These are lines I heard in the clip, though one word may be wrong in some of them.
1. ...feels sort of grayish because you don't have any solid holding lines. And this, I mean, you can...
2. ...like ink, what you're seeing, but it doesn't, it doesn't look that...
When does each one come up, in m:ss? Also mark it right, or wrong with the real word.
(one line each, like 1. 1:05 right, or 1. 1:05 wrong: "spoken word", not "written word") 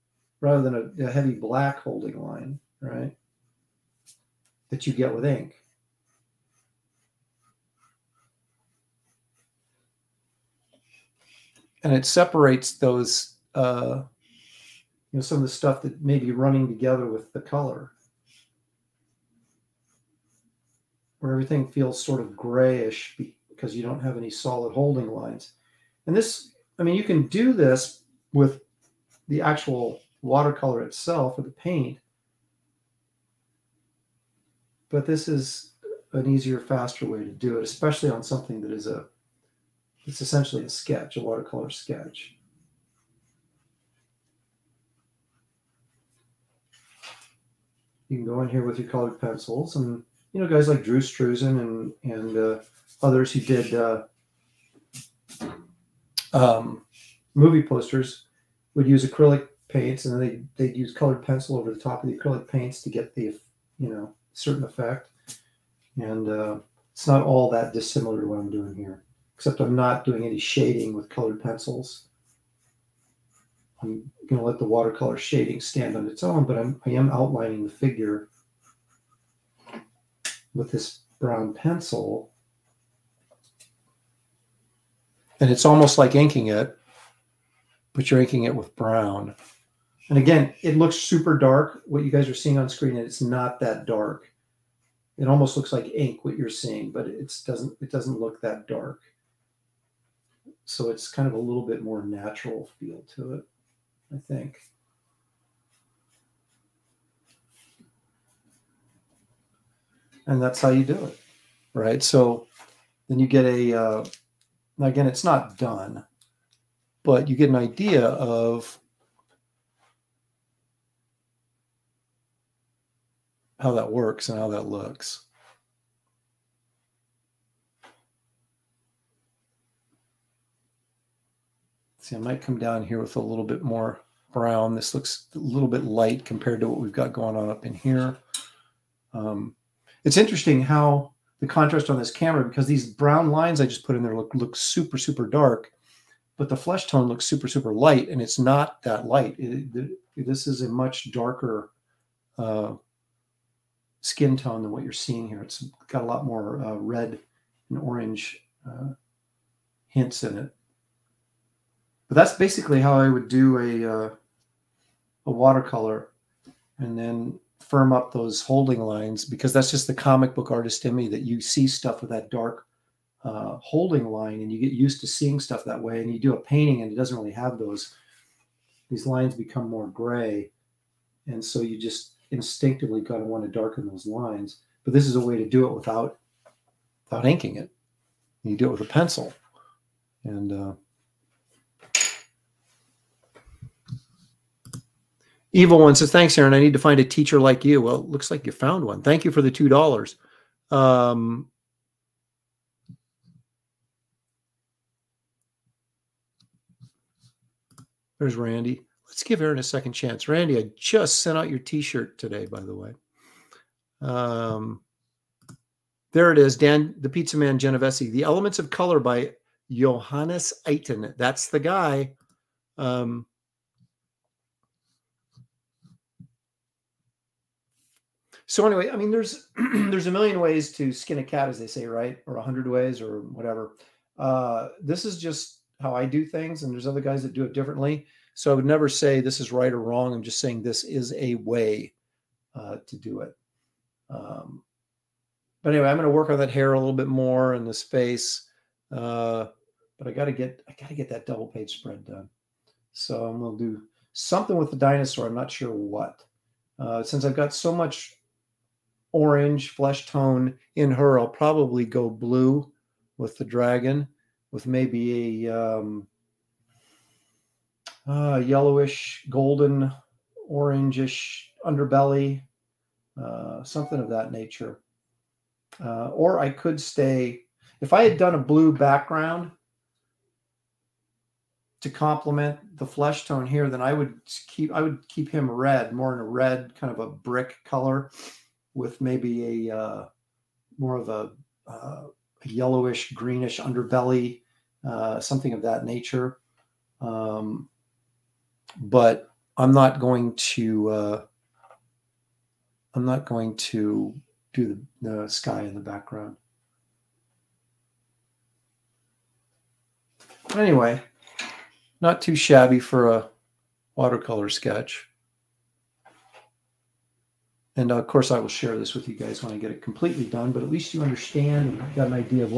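1. 0:21 right
2. 1:35 right.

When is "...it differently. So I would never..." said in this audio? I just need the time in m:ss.
3:57.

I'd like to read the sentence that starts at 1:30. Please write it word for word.
And again, it looks super dark.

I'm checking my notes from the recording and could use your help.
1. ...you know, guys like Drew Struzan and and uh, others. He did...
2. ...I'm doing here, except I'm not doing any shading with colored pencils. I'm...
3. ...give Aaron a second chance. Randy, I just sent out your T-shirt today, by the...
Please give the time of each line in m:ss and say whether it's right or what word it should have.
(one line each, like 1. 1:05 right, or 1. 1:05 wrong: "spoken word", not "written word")
1. 0:50 right
2. 1:08 right
3. 3:29 right.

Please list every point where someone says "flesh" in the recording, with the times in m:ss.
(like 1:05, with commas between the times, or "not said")
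2:26, 4:19, 4:42.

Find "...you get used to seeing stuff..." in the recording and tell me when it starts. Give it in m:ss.
2:54.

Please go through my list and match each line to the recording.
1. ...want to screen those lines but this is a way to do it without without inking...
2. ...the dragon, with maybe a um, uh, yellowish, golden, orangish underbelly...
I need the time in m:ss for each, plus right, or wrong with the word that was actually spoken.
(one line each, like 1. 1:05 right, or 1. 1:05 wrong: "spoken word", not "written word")
1. 3:03 wrong: "darken", not "screen"
2. 4:23 right.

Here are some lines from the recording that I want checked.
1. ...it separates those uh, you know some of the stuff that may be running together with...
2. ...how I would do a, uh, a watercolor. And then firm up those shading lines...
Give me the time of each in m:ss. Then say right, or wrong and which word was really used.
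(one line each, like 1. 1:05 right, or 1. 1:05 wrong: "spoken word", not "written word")
1. 0:11 right
2. 2:42 wrong: "holding", not "shading".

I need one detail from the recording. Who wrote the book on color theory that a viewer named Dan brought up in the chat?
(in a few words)
Johannes Itten.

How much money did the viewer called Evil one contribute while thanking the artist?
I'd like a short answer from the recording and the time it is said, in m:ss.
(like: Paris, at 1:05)
$2, at 3:19.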